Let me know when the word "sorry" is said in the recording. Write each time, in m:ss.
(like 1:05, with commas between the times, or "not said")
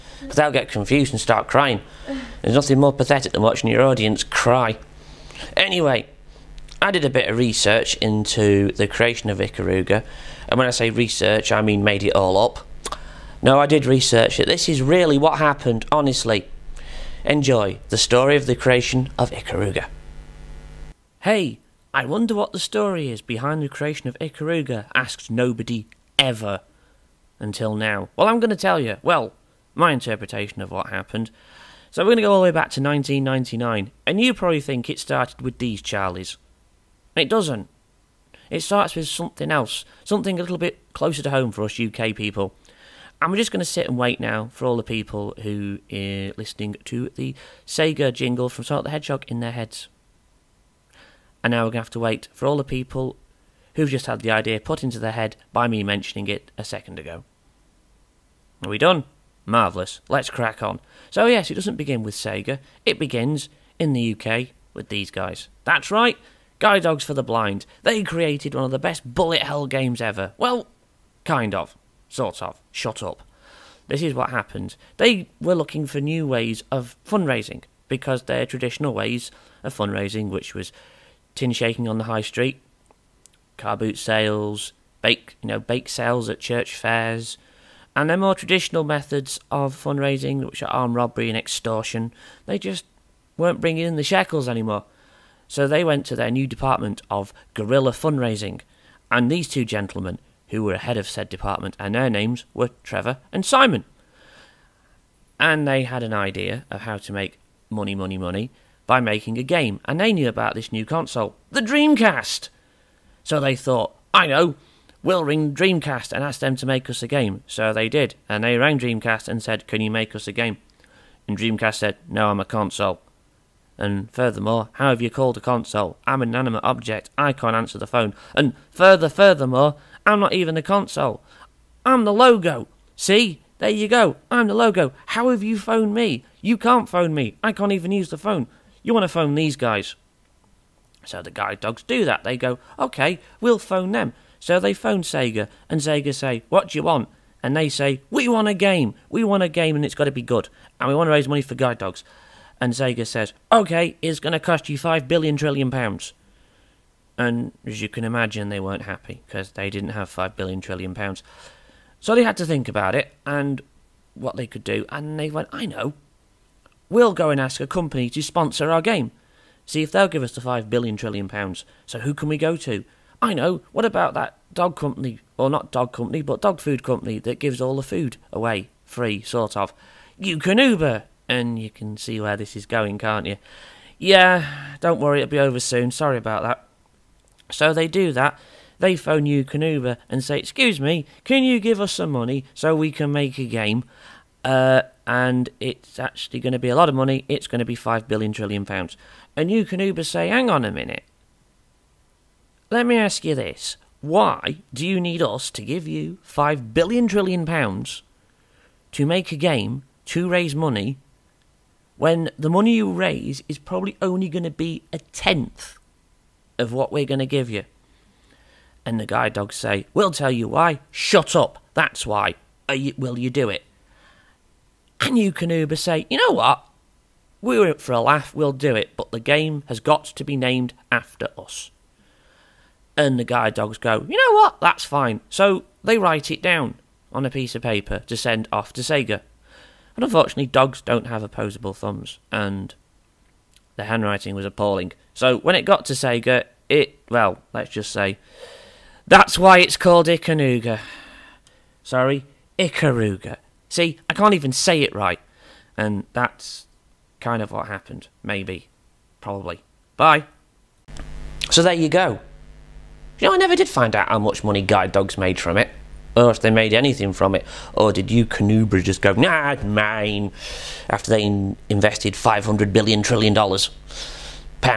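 3:05, 4:11.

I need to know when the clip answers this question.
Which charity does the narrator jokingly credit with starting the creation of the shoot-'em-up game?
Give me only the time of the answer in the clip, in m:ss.
1:06.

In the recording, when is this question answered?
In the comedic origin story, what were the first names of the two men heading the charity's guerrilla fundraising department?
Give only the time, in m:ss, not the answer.
1:42.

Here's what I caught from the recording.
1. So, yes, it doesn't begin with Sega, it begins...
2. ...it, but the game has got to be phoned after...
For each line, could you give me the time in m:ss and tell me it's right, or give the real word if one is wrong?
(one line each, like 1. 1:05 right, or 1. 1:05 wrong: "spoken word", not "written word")
1. 1:01 right
2. 3:48 wrong: "named", not "phoned".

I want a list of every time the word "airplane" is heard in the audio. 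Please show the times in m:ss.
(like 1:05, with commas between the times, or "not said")
not said.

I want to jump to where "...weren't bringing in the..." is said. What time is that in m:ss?
1:33.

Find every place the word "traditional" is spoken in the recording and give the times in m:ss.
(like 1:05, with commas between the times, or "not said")
1:18, 1:28.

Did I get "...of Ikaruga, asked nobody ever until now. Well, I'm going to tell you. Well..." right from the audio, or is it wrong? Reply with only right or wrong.
right.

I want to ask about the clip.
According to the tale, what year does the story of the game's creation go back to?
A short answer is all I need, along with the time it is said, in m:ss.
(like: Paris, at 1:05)
1999, at 0:32.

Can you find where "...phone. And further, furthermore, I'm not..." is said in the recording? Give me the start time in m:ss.
2:07.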